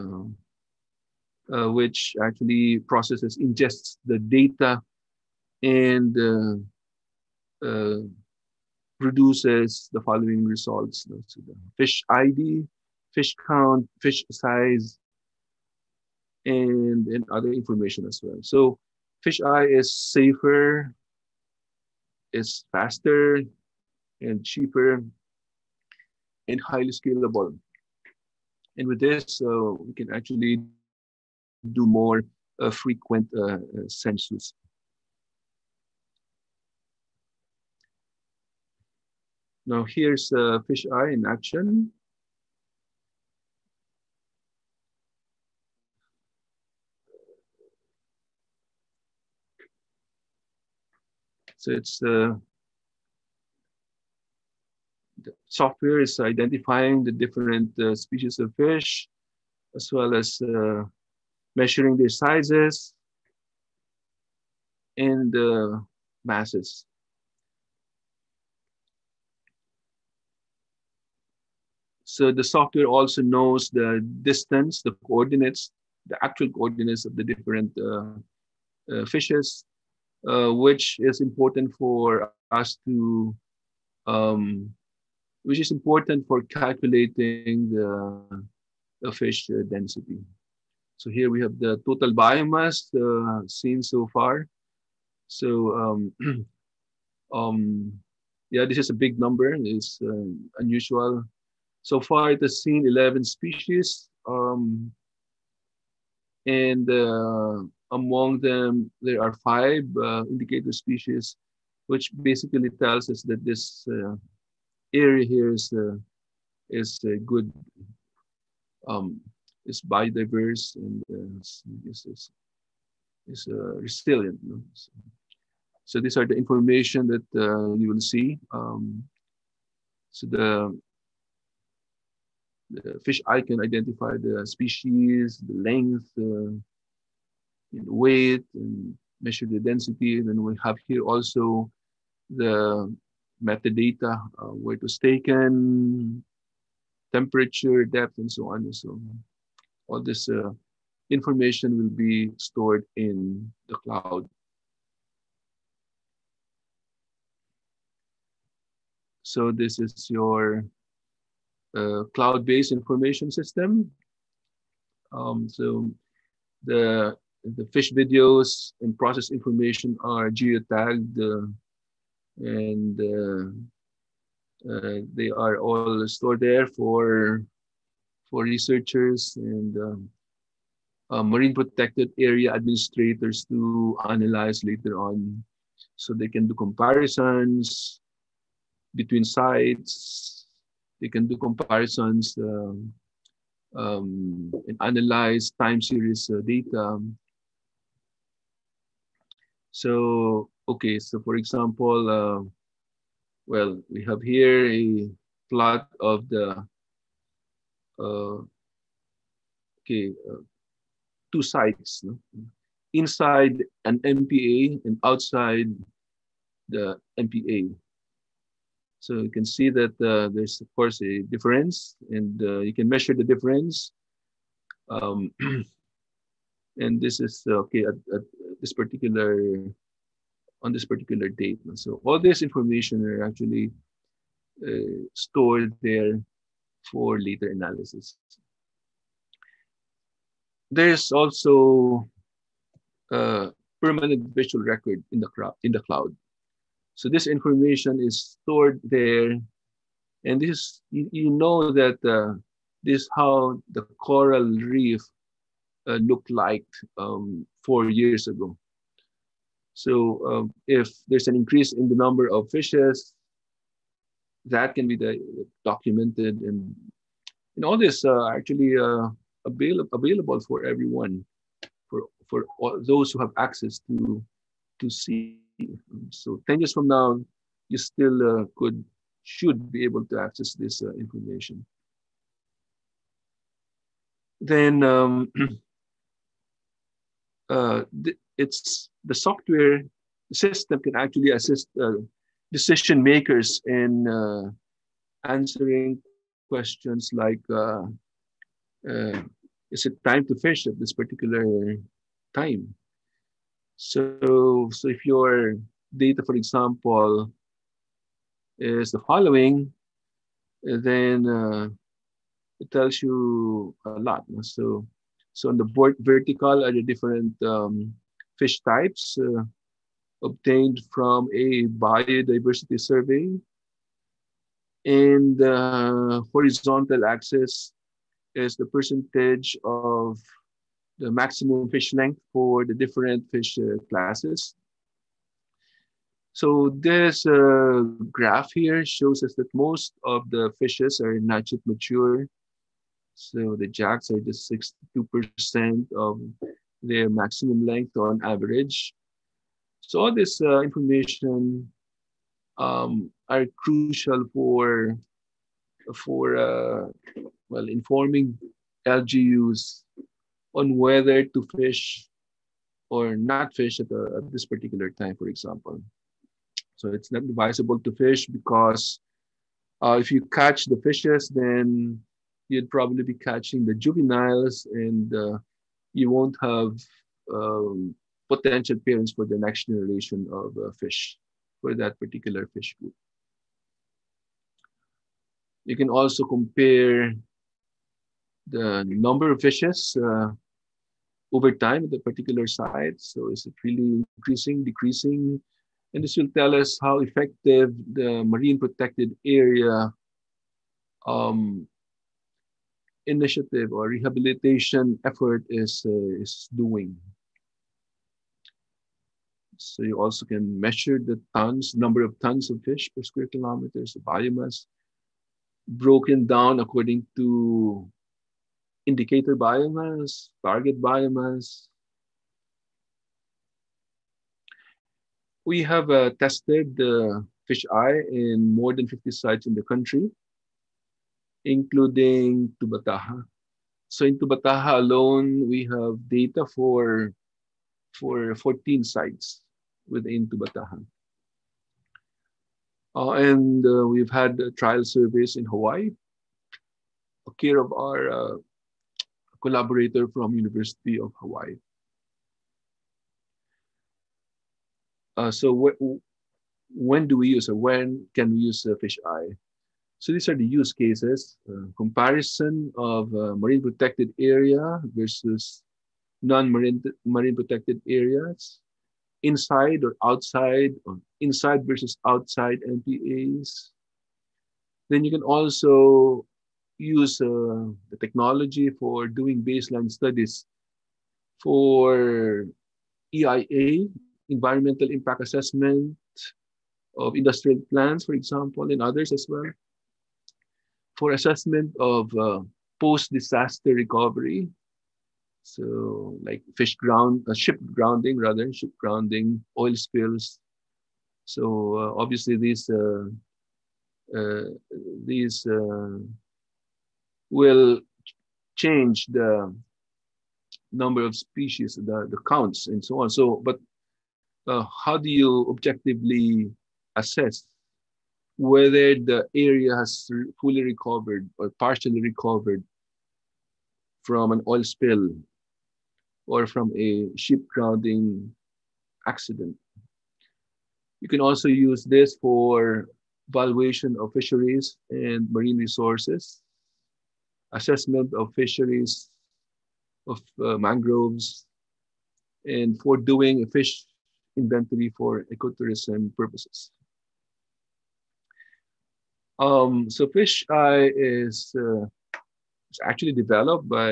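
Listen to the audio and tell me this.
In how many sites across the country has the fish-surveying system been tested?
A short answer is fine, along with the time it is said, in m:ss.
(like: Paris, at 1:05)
More than 50, at 7:08.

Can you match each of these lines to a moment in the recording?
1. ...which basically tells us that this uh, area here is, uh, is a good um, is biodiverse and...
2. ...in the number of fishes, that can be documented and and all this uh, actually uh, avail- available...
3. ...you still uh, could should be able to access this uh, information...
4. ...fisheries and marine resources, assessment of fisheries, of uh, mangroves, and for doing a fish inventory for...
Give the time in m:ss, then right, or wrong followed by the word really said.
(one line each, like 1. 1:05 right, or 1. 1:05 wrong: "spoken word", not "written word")
1. 1:51 right
2. 4:21 right
3. 4:37 right
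4. 8:54 right.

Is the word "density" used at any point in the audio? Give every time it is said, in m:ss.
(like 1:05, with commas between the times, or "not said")
1:29, 2:19.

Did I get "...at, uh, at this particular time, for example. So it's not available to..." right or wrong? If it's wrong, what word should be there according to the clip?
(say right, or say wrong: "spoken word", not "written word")
wrong: "advisable", not "available".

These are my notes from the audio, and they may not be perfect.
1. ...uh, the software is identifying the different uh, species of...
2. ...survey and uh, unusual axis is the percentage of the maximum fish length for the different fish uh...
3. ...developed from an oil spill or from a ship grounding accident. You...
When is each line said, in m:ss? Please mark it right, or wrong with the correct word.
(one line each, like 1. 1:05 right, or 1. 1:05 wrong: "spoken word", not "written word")
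1. 0:52 right
2. 5:22 wrong: "horizontal", not "unusual"
3. 8:41 wrong: "recovered", not "developed".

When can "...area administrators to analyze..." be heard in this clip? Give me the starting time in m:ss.
3:02.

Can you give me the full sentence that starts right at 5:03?
So, so if your data, for example, is the following, then uh, it tells you a lot.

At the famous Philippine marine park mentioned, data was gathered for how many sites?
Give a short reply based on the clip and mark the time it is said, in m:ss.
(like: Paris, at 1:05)
14, at 7:18.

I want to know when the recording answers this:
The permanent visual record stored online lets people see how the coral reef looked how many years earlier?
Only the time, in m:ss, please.
4:17.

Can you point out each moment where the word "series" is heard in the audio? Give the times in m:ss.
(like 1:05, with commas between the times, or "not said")
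3:15.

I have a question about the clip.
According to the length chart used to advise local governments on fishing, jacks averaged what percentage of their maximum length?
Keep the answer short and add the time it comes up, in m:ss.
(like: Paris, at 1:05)
62%, at 5:44.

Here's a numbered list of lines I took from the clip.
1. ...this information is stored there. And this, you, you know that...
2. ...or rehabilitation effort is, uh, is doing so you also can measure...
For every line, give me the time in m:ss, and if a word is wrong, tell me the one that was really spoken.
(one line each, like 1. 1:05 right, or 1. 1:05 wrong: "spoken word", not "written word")
1. 4:07 right
2. 6:43 right.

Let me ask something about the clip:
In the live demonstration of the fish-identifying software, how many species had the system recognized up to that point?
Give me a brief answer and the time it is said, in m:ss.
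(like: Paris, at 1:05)
11, at 1:42.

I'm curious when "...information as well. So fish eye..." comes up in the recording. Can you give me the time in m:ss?
0:17.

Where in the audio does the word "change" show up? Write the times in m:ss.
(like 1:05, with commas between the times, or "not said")
8:28.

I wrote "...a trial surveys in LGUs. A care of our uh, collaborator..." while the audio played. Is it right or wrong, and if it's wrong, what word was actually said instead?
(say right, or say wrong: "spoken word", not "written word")
wrong: "Hawaii", not "LGUs".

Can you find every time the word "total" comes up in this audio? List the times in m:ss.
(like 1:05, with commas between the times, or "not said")
1:31.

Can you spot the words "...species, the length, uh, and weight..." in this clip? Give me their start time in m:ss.
2:14.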